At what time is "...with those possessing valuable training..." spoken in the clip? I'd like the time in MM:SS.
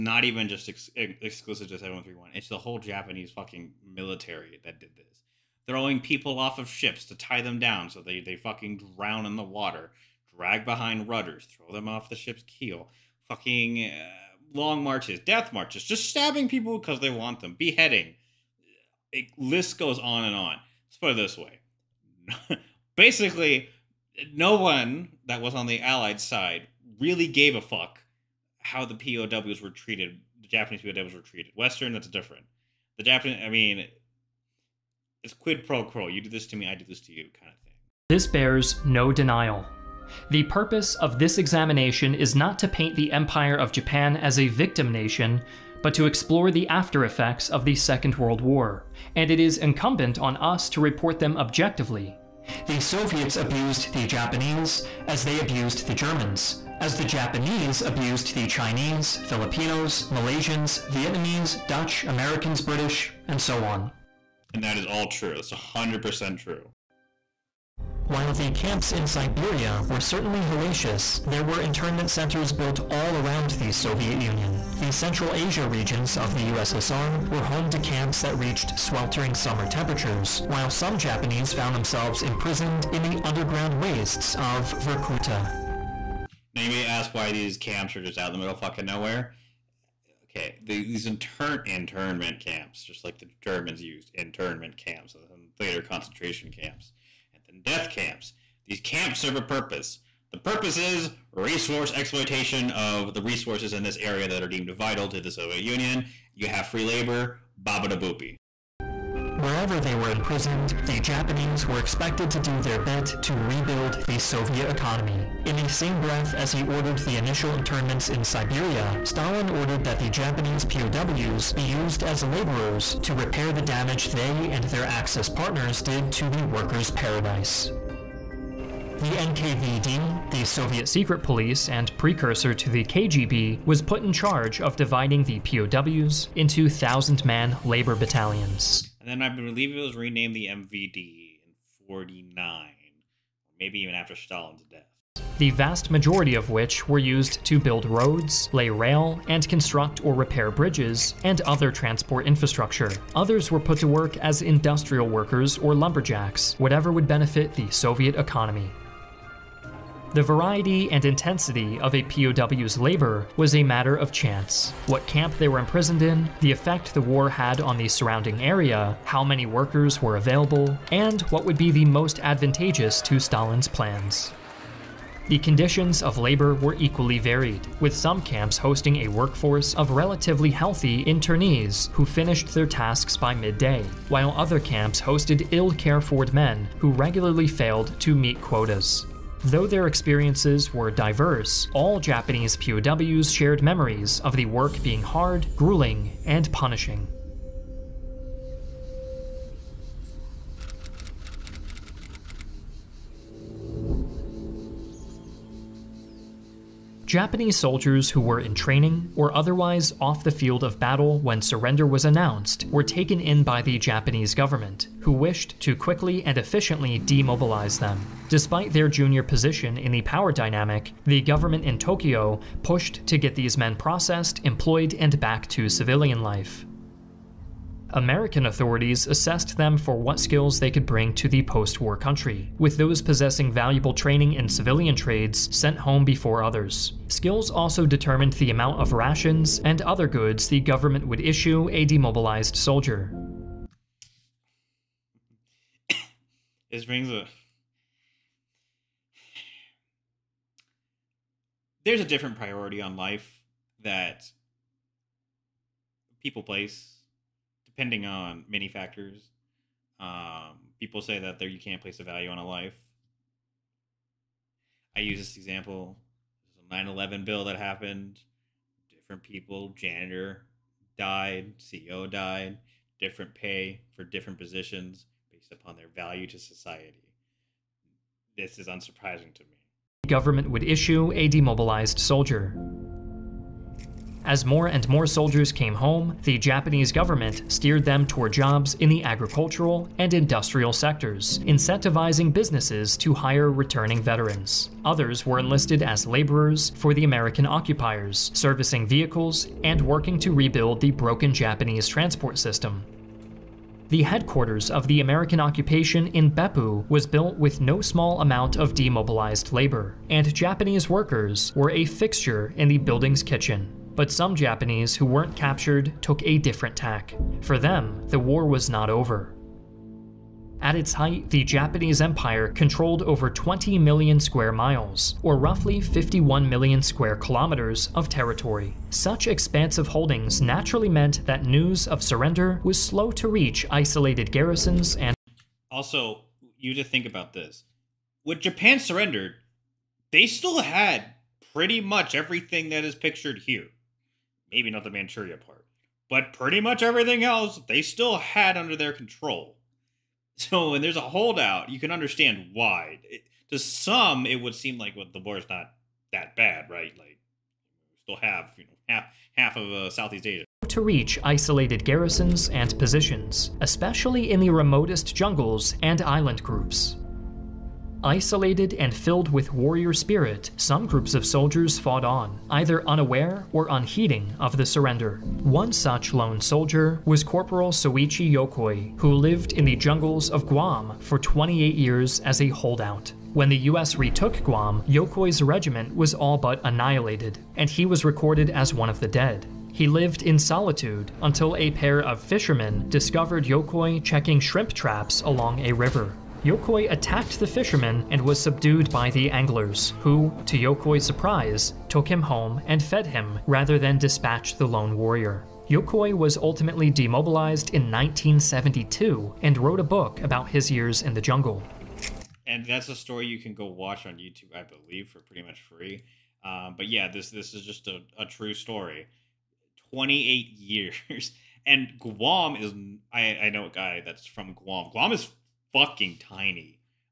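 03:52.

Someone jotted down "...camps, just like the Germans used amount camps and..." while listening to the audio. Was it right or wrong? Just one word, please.
wrong.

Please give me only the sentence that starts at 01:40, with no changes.
The purpose is resource exploitation of the resources in this area that are deemed vital to the Soviet Union.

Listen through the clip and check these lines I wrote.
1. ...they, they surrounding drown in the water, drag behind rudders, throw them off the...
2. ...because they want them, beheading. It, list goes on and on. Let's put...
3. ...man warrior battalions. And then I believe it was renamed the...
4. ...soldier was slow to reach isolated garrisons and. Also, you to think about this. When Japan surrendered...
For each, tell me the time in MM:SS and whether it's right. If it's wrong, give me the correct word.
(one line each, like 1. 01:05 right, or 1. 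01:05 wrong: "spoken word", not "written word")
1. 00:08 wrong: "fucking", not "surrounding"
2. 00:16 right
3. 02:17 wrong: "labor", not "warrior"
4. 05:32 wrong: "surrender", not "soldier".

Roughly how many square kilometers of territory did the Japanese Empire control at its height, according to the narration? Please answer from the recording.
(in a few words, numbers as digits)
51 million.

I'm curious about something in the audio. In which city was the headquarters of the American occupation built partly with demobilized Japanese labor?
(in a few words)
Beppu.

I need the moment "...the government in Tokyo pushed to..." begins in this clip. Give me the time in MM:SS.
03:41.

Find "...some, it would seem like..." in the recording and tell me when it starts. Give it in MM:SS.
05:53.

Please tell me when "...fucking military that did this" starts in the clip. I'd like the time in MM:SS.
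00:03.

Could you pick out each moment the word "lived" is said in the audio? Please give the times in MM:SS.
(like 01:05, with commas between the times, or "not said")
06:19, 06:29.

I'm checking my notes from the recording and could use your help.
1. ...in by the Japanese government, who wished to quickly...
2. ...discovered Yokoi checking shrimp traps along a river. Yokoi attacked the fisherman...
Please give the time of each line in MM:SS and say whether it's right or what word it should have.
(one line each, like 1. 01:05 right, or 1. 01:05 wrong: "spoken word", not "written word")
1. 03:33 right
2. 06:32 right.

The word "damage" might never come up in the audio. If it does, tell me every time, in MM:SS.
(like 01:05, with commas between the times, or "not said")
02:03.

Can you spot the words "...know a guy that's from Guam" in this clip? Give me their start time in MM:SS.
07:03.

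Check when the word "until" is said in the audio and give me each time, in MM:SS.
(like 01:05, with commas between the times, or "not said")
06:31.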